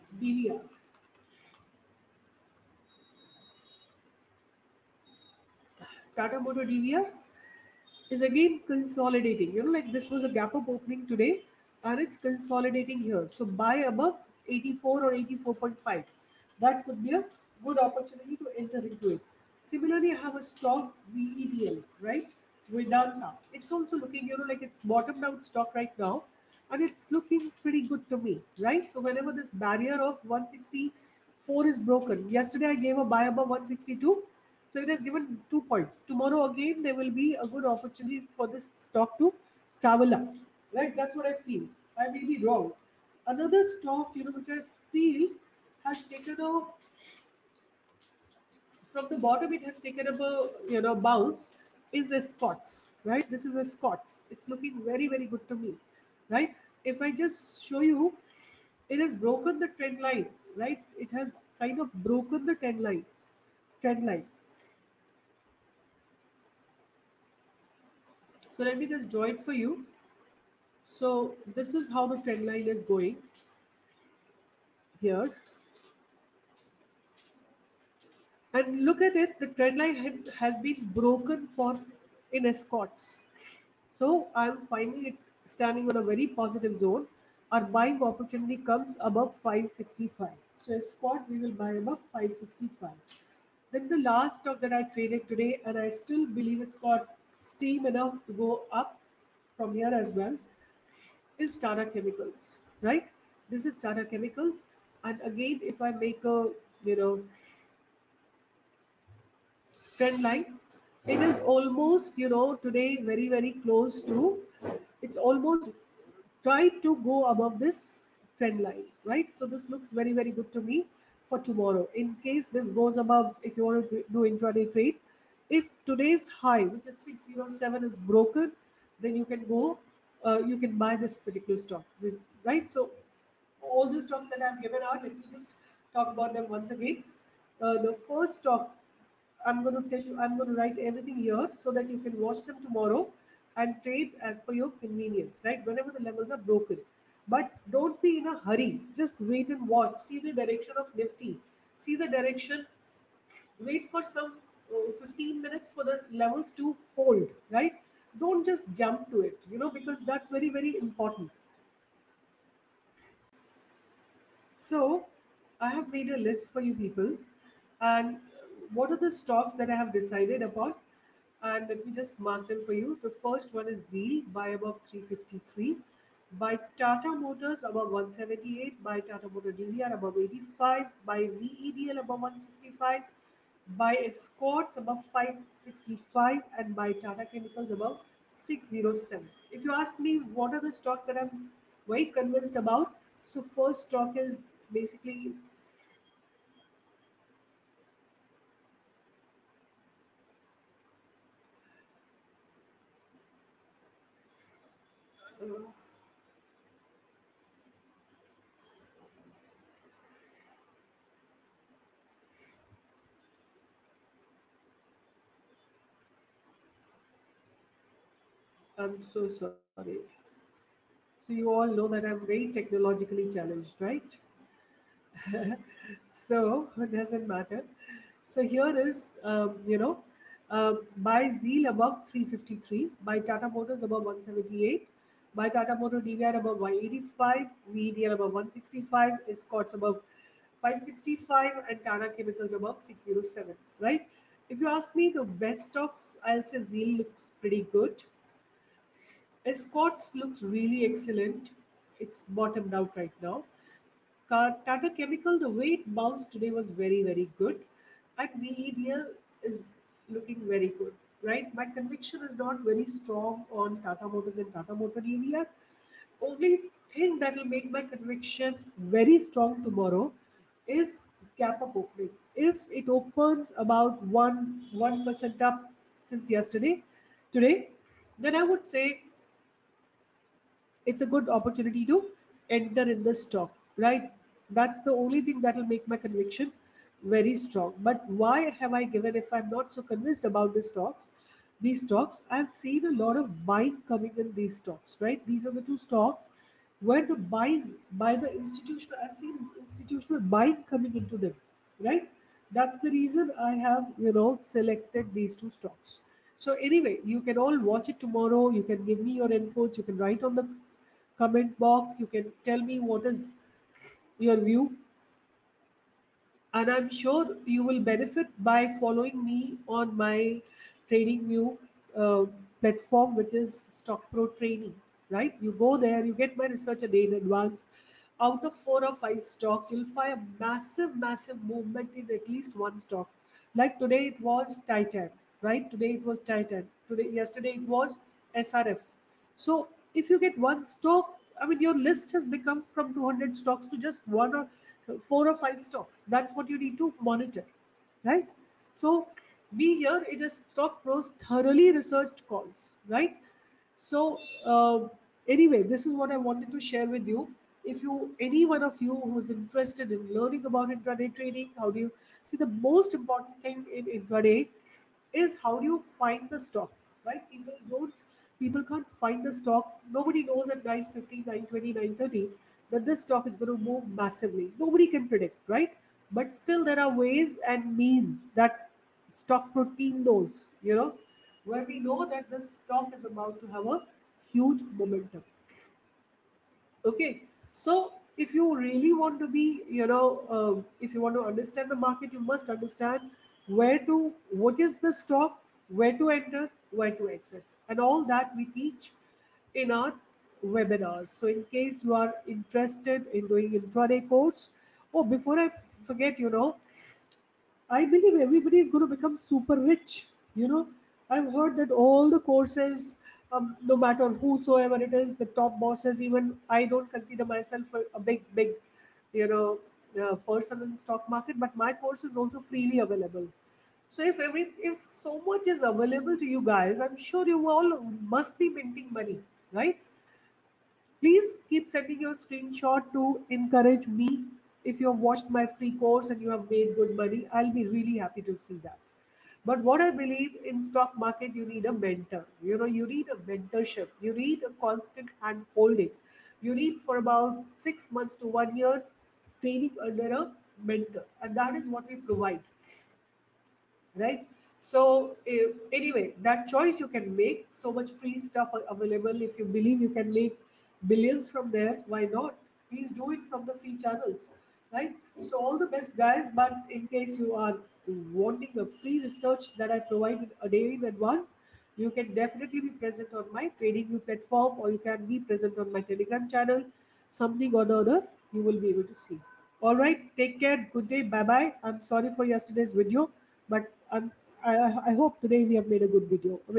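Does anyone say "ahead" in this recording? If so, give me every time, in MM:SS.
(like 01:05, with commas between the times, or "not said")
not said.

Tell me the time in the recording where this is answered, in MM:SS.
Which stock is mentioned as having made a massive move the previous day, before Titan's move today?
05:38.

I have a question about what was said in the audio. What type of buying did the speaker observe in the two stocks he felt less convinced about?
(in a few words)
Institutional buying.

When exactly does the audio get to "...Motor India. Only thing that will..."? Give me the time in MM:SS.
04:24.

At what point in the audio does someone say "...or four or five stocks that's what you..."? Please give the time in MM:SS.
05:44.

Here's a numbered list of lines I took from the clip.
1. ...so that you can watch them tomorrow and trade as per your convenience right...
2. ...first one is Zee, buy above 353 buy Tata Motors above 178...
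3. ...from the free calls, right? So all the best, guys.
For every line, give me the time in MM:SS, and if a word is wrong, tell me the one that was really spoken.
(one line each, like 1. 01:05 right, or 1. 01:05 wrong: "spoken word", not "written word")
1. 02:21 right
2. 02:53 right
3. 07:43 wrong: "channels", not "calls".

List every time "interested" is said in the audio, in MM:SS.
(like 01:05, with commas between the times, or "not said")
05:59, 06:42.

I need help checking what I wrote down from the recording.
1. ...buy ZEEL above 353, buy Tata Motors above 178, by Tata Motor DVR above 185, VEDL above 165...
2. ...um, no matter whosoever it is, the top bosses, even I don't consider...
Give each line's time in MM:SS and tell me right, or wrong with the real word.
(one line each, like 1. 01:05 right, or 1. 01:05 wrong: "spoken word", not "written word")
1. 03:50 right
2. 06:53 right.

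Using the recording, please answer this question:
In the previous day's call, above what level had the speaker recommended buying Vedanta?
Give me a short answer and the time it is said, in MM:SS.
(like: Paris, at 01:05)
162, at 00:33.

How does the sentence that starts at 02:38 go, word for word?
Don't just jump to it, you know, because that's very, very important.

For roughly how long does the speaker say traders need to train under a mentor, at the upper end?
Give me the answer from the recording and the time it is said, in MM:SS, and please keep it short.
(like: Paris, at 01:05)
1 year, at 07:28.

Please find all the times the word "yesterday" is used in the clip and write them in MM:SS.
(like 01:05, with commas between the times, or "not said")
00:32, 04:36, 05:37, 08:02.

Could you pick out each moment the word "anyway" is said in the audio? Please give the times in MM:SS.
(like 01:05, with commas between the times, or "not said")
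05:06, 05:55, 07:35.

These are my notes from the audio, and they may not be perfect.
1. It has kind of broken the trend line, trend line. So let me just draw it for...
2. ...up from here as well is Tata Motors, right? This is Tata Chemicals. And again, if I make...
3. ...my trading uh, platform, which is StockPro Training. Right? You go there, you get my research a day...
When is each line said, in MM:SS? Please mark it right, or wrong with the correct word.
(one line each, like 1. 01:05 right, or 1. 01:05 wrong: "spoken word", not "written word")
1. 01:00 right
2. 01:38 wrong: "Chemicals", not "Motors"
3. 05:19 right.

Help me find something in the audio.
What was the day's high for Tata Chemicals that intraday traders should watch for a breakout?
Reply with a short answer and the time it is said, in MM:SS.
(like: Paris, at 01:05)
607, at 02:07.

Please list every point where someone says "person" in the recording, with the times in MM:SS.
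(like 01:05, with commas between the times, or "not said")
07:00.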